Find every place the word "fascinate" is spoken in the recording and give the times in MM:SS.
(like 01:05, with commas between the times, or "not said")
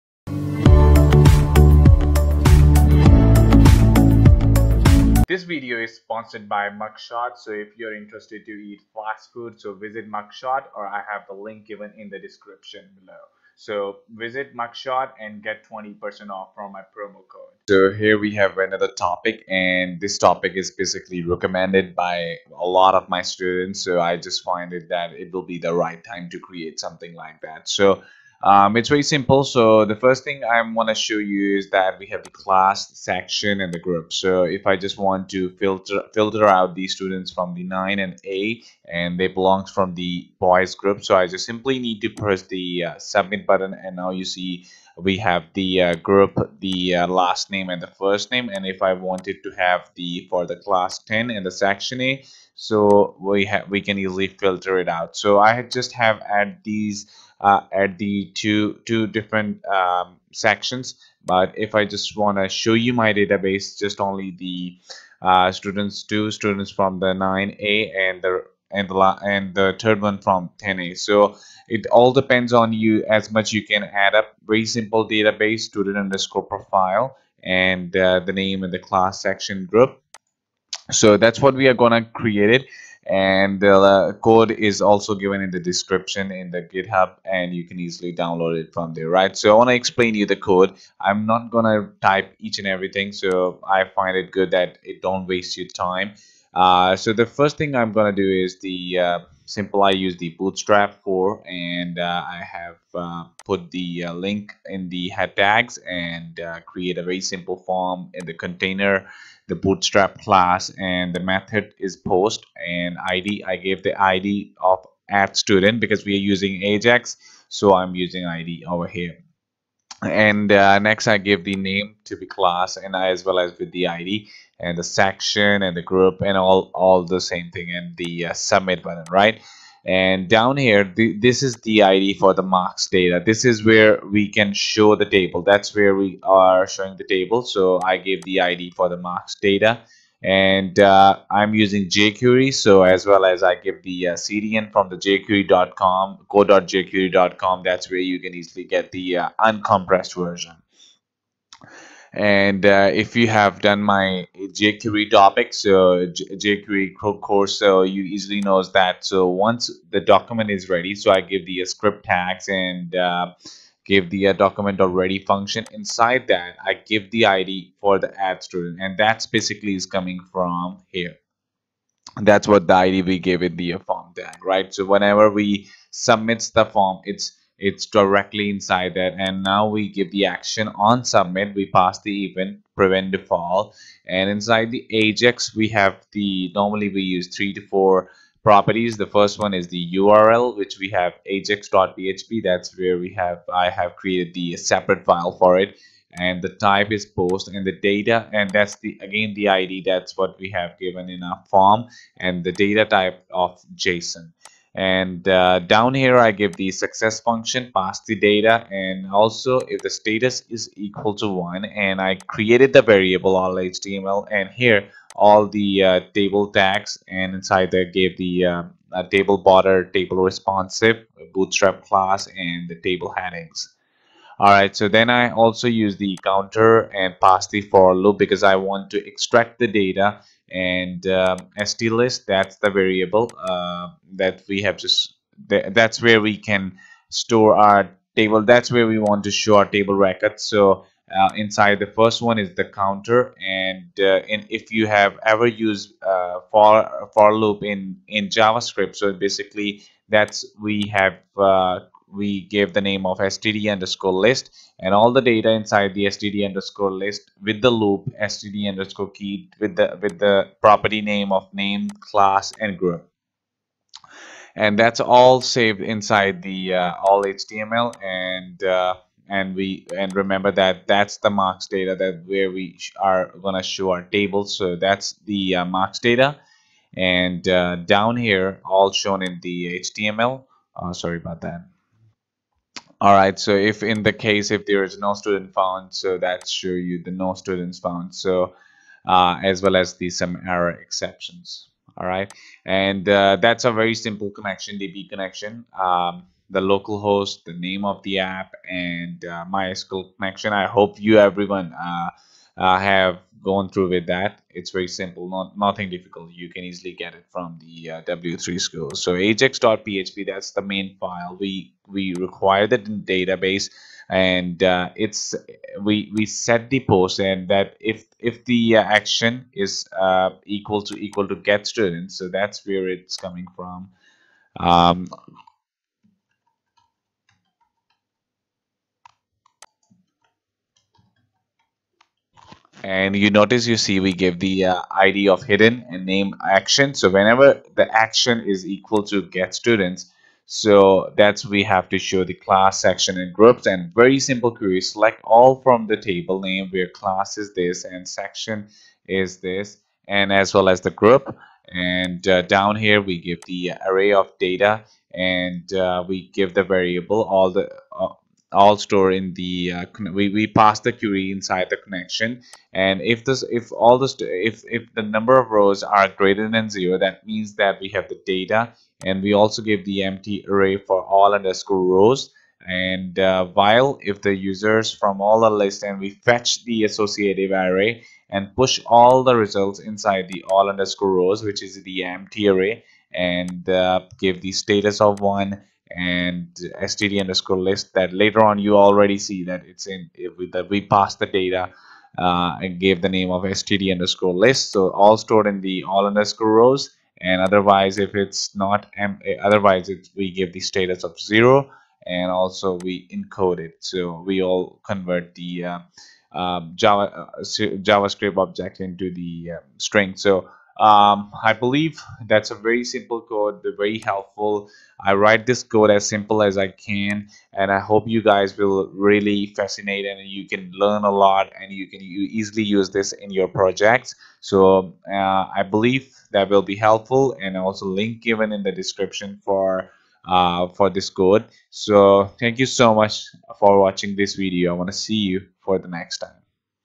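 06:59.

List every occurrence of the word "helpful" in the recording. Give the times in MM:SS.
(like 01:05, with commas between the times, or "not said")
06:53, 07:06.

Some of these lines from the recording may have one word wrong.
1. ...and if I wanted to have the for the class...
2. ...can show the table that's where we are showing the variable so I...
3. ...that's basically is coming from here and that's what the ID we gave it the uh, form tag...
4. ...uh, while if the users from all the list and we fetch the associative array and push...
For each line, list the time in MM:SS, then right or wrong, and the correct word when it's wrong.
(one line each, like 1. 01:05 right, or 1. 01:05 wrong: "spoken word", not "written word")
1. 00:48 right
2. 02:14 wrong: "table", not "variable"
3. 02:48 right
4. 06:13 right.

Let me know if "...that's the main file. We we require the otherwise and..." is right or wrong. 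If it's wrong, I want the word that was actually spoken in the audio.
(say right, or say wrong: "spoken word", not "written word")
wrong: "database", not "otherwise".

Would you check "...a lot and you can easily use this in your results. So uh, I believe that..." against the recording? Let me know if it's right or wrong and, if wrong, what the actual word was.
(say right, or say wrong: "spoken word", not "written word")
wrong: "projects", not "results".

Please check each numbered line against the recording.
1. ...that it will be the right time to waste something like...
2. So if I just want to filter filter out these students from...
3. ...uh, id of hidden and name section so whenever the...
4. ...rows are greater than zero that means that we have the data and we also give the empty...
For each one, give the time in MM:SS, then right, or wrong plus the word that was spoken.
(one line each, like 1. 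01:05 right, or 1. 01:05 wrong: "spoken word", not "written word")
1. 00:24 wrong: "create", not "waste"
2. 00:34 right
3. 05:34 wrong: "action", not "section"
4. 06:05 right.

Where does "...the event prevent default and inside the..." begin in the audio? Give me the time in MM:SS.
03:02.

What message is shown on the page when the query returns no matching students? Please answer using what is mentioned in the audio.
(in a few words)
No students found.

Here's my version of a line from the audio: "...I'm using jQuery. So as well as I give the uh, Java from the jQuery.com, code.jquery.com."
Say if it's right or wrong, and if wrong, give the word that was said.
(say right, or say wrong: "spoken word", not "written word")
wrong: "CDN", not "Java".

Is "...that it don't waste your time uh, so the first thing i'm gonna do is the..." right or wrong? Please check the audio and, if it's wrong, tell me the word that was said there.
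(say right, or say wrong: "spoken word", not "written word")
right.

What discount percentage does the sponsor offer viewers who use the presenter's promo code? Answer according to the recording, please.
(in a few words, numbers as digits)
20%.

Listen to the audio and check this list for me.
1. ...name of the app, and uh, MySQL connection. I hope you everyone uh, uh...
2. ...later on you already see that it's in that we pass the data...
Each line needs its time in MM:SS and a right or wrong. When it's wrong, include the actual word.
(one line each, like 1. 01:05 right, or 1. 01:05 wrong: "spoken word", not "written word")
1. 04:57 right
2. 06:28 right.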